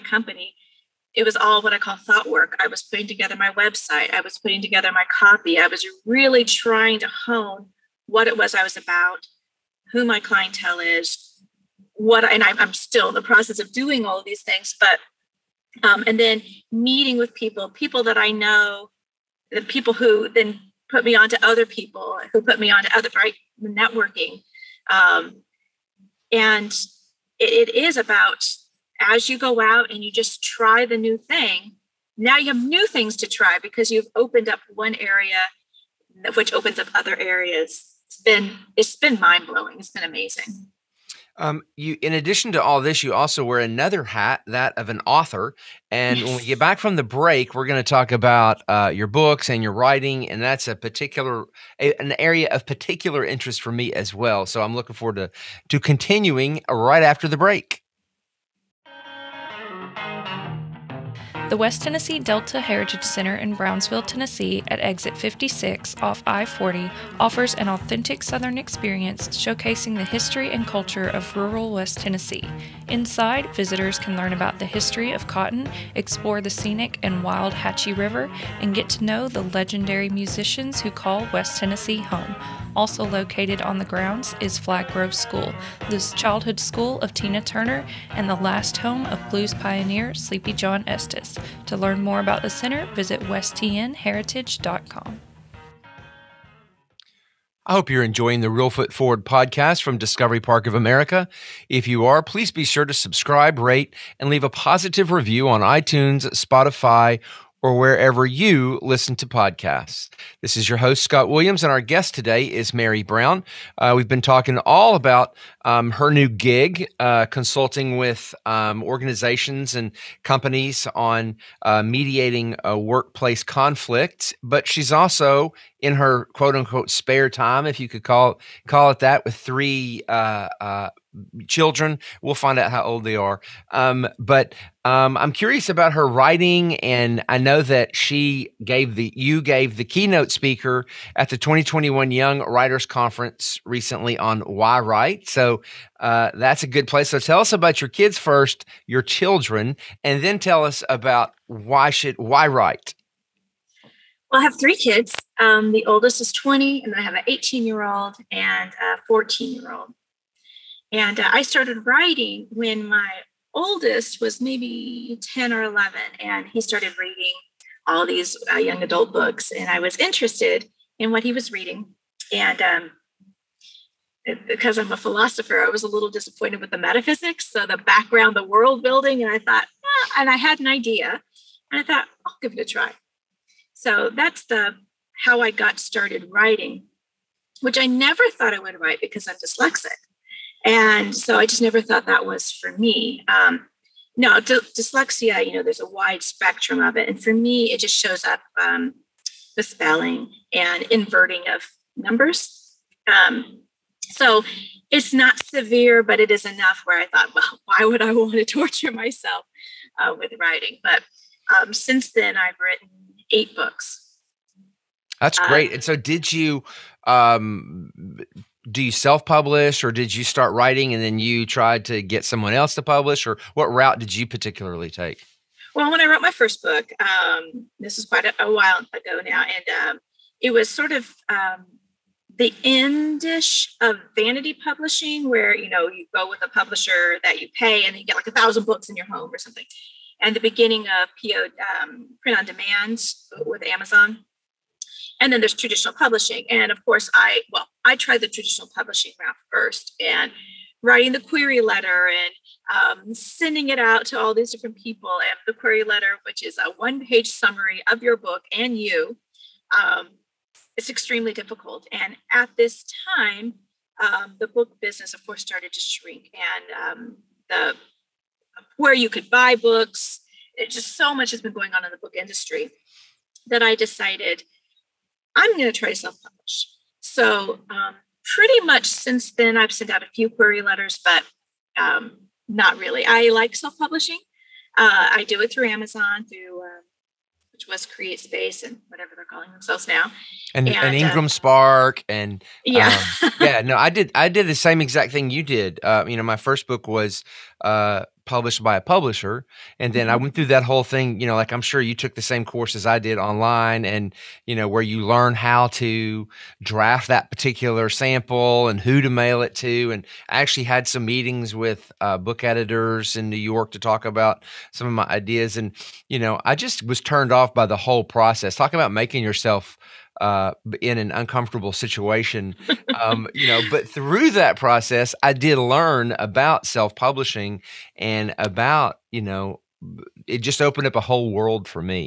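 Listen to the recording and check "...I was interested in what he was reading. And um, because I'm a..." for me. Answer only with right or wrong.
right.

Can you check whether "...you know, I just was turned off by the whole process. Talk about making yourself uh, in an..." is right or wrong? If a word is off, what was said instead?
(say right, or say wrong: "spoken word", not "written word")
right.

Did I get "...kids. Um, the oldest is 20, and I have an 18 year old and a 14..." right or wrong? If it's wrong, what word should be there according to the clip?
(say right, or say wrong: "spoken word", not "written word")
right.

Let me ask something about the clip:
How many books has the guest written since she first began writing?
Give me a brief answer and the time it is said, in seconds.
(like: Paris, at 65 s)
8, at 213 s.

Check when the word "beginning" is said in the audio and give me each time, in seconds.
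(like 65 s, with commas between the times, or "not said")
240 s.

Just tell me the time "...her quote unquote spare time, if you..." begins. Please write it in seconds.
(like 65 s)
125 s.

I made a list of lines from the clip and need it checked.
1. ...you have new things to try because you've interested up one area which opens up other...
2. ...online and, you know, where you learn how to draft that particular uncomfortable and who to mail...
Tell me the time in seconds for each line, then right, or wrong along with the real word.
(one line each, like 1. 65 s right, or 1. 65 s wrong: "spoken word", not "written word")
1. 32 s wrong: "opened", not "interested"
2. 303 s wrong: "sample", not "uncomfortable".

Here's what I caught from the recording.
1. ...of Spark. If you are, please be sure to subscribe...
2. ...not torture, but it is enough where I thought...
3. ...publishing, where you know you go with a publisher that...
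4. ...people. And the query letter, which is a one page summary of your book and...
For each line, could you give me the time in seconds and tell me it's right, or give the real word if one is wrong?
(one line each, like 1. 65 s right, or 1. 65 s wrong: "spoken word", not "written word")
1. 100 s wrong: "America", not "Spark"
2. 205 s wrong: "severe", not "torture"
3. 234 s right
4. 254 s right.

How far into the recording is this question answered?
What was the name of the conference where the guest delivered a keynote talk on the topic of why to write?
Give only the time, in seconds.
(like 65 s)
142 s.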